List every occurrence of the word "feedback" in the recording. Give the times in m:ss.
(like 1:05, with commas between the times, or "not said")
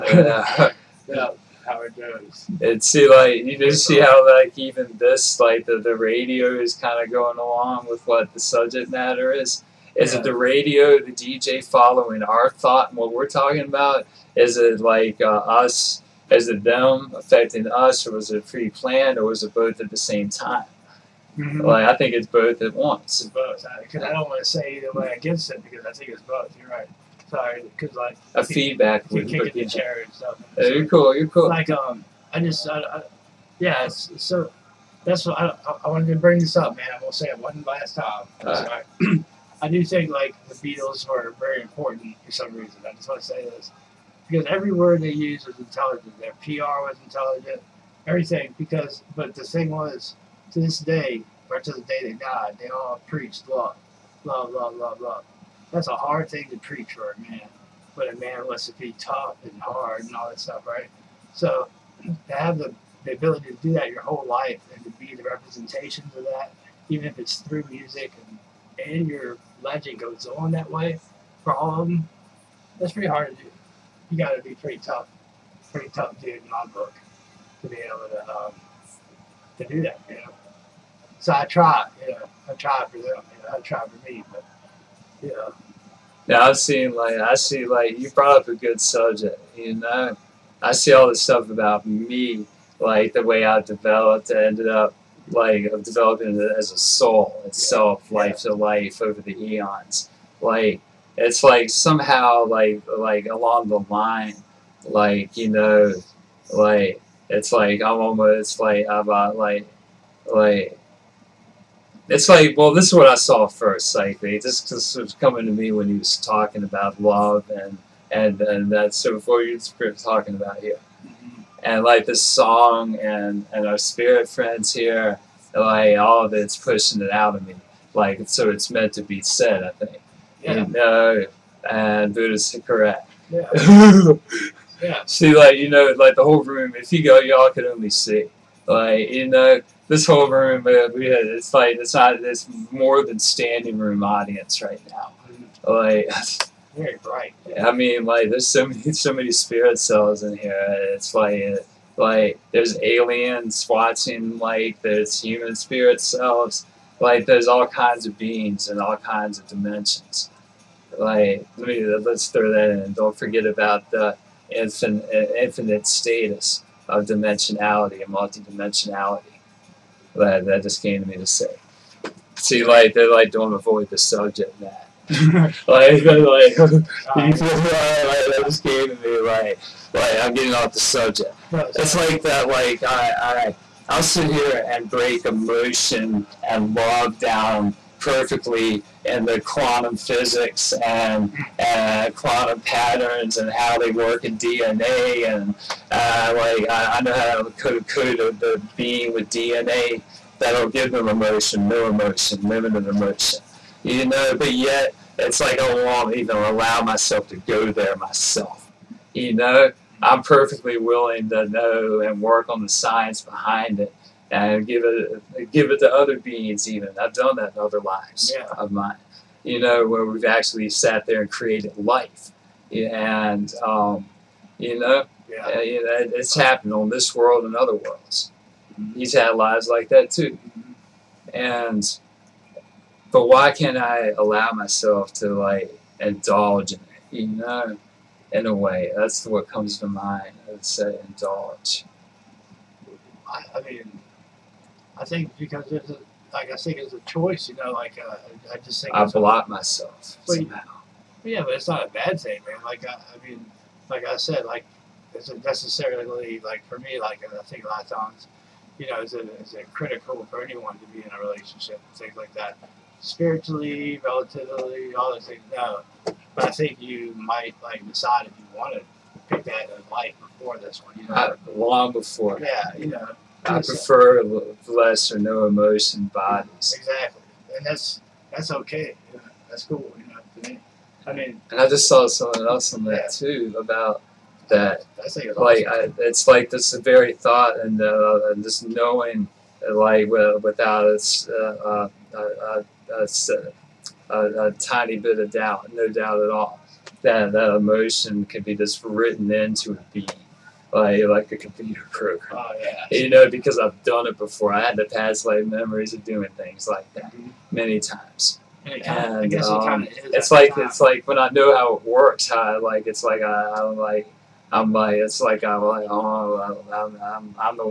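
0:28.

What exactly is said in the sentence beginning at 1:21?
So I try, you know, I try for them, you know, I try for me, but yeah.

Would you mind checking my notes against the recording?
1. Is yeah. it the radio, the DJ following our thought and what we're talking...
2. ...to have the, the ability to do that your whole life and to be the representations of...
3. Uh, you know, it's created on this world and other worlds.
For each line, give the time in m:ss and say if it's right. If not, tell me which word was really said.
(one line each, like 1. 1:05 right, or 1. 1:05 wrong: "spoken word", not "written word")
1. 0:09 right
2. 1:02 right
3. 3:45 wrong: "happened", not "created".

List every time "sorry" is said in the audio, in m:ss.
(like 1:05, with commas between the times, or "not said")
0:27, 0:38.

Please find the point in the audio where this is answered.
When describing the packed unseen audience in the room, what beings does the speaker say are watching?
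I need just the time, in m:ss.
2:32.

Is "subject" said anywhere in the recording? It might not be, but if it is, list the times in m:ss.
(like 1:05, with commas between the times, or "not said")
0:08, 1:28, 2:53, 3:00.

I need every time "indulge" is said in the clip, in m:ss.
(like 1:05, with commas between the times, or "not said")
3:55, 4:01.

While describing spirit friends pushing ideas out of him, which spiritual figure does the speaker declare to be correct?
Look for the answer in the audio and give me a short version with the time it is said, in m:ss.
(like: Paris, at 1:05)
Buddha, at 2:12.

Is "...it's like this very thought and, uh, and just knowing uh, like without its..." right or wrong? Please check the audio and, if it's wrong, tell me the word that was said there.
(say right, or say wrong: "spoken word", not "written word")
right.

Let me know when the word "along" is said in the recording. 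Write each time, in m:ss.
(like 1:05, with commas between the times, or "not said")
0:07, 1:43.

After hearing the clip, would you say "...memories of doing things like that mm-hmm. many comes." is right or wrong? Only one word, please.
wrong.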